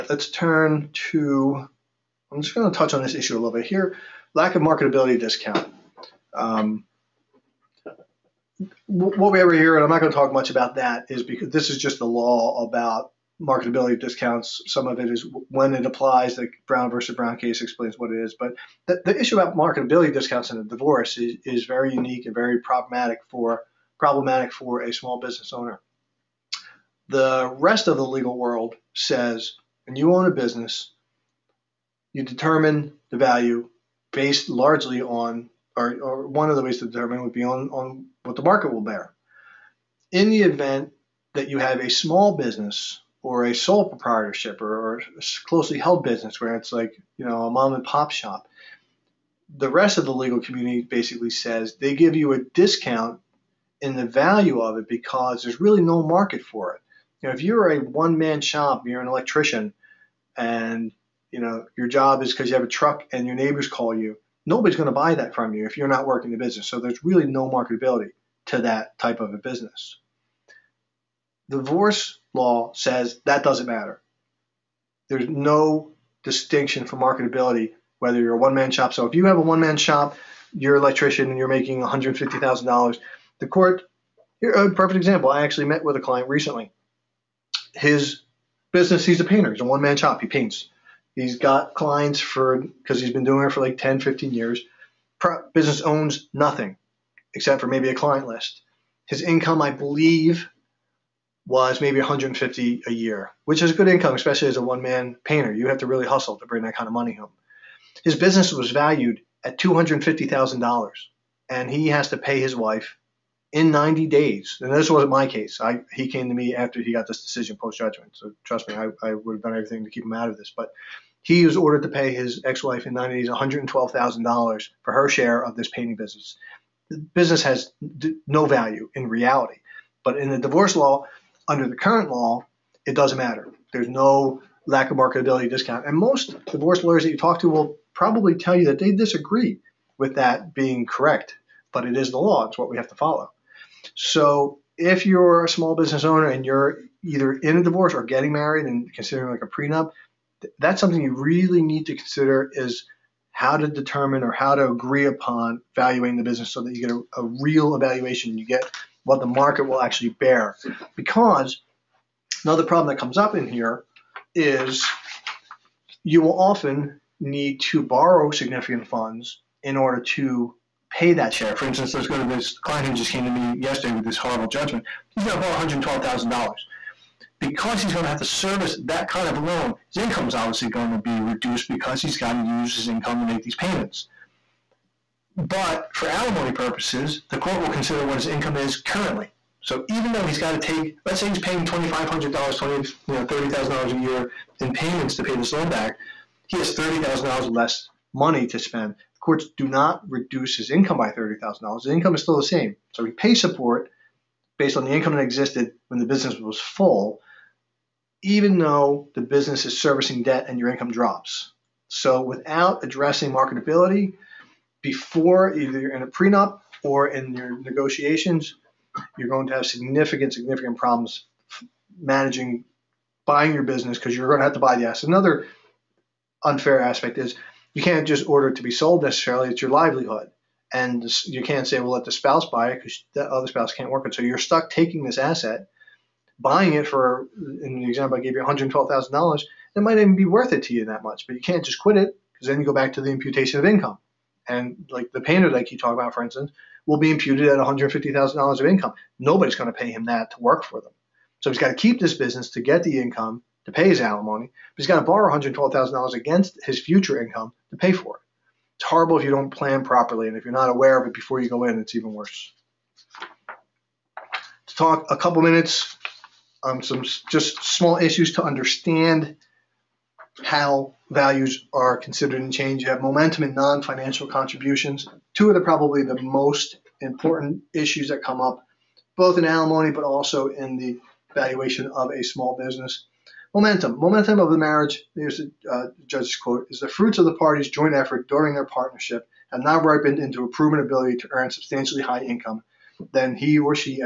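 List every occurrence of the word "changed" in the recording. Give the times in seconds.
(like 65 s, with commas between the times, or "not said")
272 s.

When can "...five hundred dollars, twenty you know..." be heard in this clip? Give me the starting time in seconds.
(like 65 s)
191 s.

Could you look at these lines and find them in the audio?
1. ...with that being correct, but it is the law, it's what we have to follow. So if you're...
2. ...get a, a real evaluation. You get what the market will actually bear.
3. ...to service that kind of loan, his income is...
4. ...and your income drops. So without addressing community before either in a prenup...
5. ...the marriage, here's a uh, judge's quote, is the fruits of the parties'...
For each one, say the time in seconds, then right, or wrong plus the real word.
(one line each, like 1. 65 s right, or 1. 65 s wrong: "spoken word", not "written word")
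1. 139 s right
2. 156 s right
3. 178 s right
4. 210 s wrong: "marketability", not "community"
5. 284 s right.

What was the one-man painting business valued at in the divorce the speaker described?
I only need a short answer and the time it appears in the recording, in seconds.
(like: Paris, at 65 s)
$250,000, at 109 s.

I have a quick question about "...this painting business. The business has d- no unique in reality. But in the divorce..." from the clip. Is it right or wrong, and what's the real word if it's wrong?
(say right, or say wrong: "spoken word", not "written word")
wrong: "value", not "unique".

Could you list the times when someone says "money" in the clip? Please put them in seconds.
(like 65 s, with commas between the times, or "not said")
106 s, 198 s.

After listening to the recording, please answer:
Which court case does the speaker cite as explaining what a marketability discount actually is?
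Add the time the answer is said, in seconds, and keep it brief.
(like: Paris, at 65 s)
Brown versus Brown, at 16 s.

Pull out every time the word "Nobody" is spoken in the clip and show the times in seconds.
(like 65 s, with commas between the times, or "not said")
64 s, 249 s.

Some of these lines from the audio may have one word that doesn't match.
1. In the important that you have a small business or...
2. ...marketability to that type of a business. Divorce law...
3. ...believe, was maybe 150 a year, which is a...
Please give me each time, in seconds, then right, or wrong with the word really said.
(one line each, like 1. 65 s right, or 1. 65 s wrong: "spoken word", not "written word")
1. 40 s wrong: "event", not "important"
2. 67 s right
3. 99 s right.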